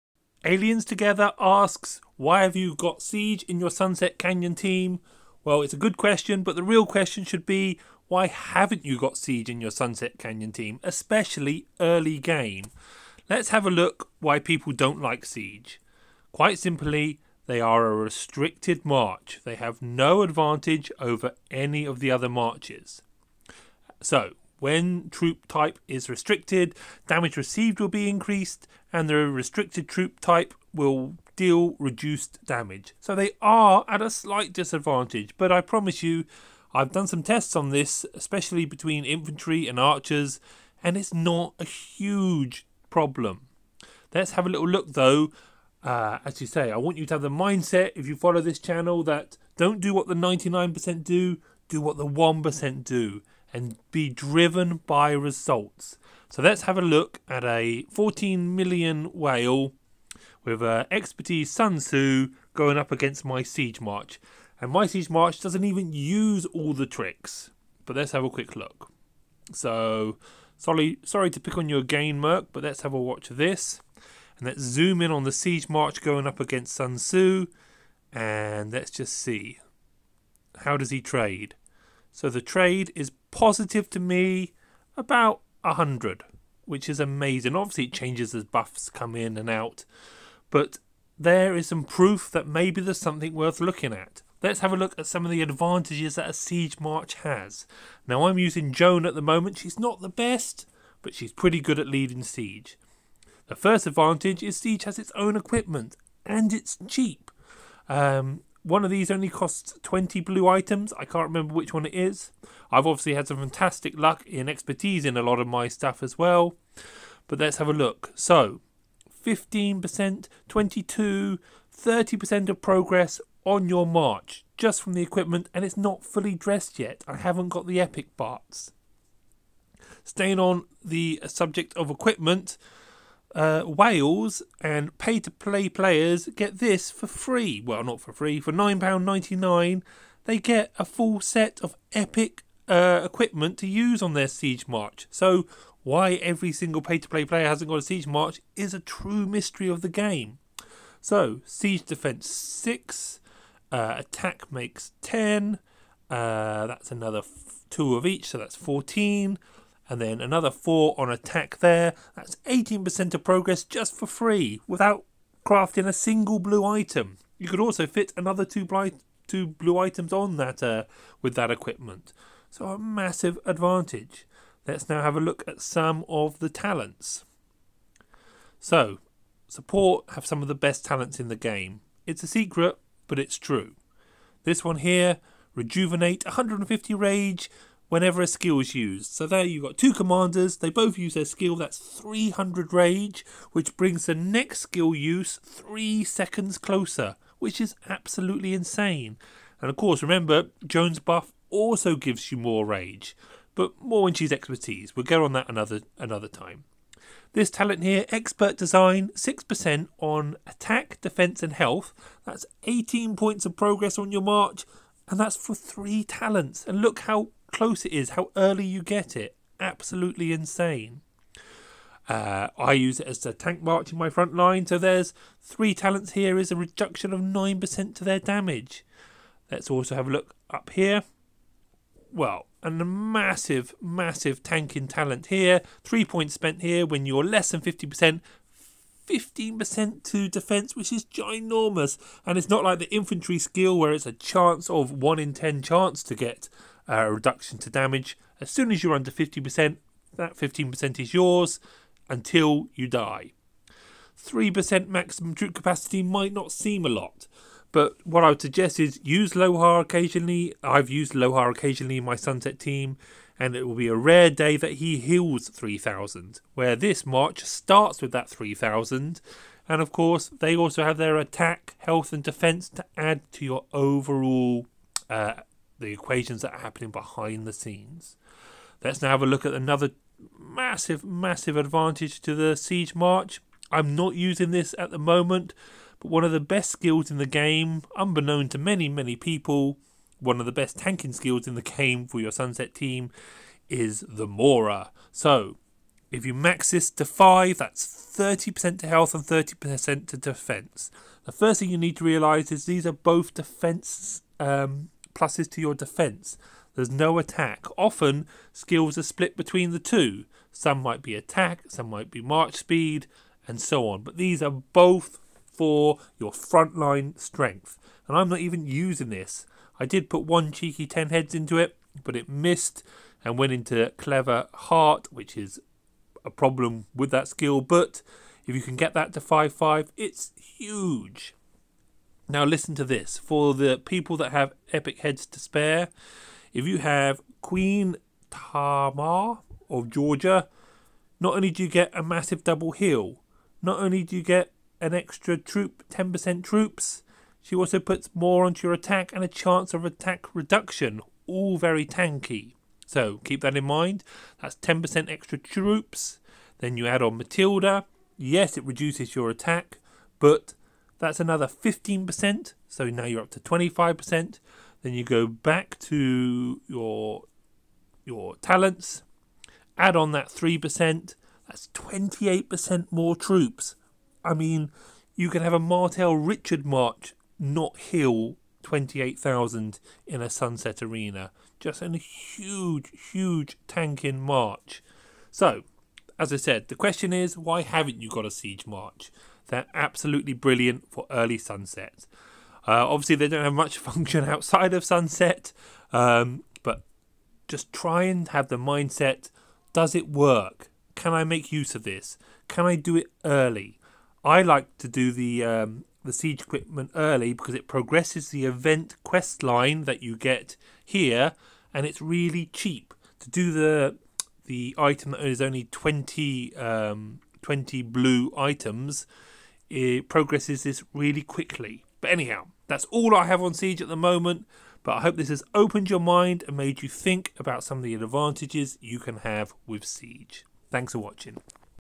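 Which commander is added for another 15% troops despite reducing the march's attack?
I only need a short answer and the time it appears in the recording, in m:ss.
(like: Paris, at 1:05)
Matilda, at 5:57.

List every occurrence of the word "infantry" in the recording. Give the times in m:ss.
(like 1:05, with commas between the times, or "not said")
0:39, 4:02.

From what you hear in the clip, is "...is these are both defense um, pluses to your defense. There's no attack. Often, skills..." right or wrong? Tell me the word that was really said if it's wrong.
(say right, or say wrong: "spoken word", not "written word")
right.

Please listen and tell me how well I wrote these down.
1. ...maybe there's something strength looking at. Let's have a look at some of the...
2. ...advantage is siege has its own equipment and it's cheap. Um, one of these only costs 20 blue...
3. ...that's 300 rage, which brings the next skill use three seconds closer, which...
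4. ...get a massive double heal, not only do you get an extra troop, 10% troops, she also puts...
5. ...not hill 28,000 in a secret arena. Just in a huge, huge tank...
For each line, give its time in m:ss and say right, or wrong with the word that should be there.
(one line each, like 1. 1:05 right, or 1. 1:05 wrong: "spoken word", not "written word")
1. 1:32 wrong: "worth", not "strength"
2. 1:43 right
3. 3:11 right
4. 5:41 right
5. 6:17 wrong: "sunset", not "secret".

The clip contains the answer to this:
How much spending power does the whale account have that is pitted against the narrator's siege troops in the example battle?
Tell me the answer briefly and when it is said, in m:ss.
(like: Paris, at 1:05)
14 million, at 0:57.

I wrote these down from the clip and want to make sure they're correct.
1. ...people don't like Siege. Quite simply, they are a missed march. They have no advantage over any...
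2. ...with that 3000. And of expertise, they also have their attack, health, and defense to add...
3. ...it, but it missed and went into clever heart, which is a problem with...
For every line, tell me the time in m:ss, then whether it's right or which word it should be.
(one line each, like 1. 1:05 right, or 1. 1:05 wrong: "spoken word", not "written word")
1. 0:14 wrong: "restricted", not "missed"
2. 4:27 wrong: "course", not "expertise"
3. 5:21 right.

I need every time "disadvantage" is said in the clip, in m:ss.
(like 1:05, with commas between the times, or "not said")
0:34.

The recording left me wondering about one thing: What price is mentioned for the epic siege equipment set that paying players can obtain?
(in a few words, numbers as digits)
£9.99.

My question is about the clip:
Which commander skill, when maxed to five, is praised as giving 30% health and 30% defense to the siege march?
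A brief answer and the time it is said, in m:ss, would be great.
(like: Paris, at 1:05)
The Mora, at 4:54.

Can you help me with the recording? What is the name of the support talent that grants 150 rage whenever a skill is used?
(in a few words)
Rejuvenate.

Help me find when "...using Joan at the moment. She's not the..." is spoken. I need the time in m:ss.
1:38.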